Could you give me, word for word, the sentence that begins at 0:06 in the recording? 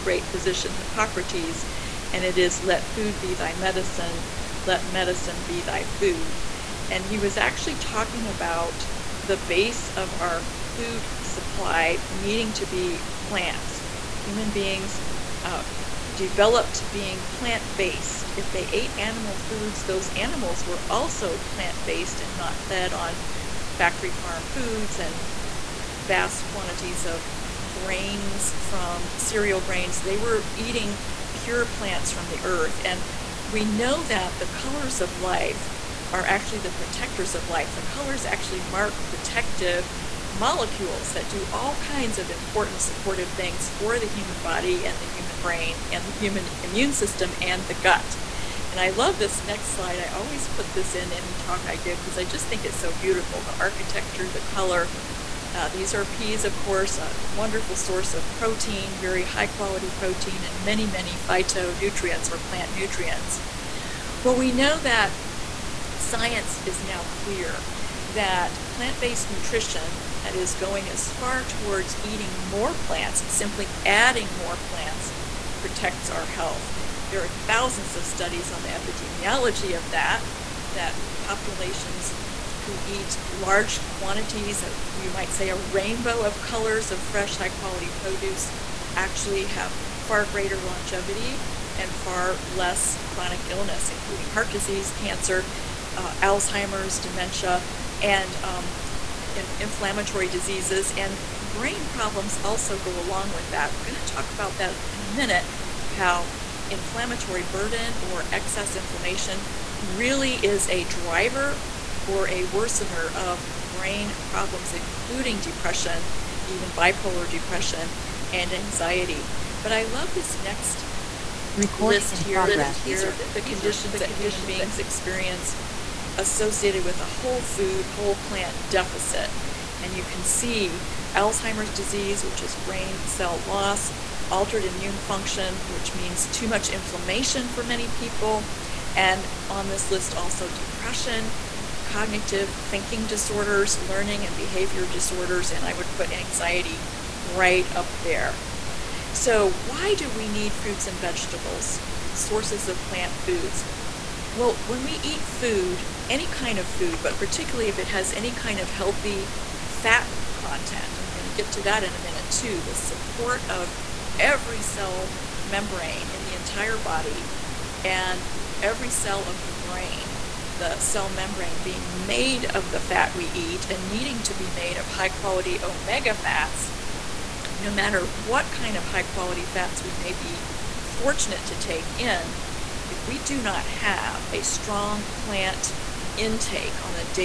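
And he was actually talking about the base of our food supply needing to be plants.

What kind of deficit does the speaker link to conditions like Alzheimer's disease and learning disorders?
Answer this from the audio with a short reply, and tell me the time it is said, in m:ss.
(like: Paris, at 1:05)
Whole food, whole plant deficit, at 2:07.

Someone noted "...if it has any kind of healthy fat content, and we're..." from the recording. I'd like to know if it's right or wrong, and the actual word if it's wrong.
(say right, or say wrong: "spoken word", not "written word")
right.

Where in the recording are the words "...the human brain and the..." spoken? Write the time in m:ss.
0:44.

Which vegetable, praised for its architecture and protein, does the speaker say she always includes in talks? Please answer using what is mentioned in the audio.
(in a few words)
Peas.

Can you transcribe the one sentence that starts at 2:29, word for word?
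So, why do we need fruits and vegetables, sources of plant foods?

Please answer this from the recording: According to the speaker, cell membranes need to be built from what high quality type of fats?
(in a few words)
Omega fats.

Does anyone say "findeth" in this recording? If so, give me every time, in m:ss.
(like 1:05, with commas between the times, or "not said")
not said.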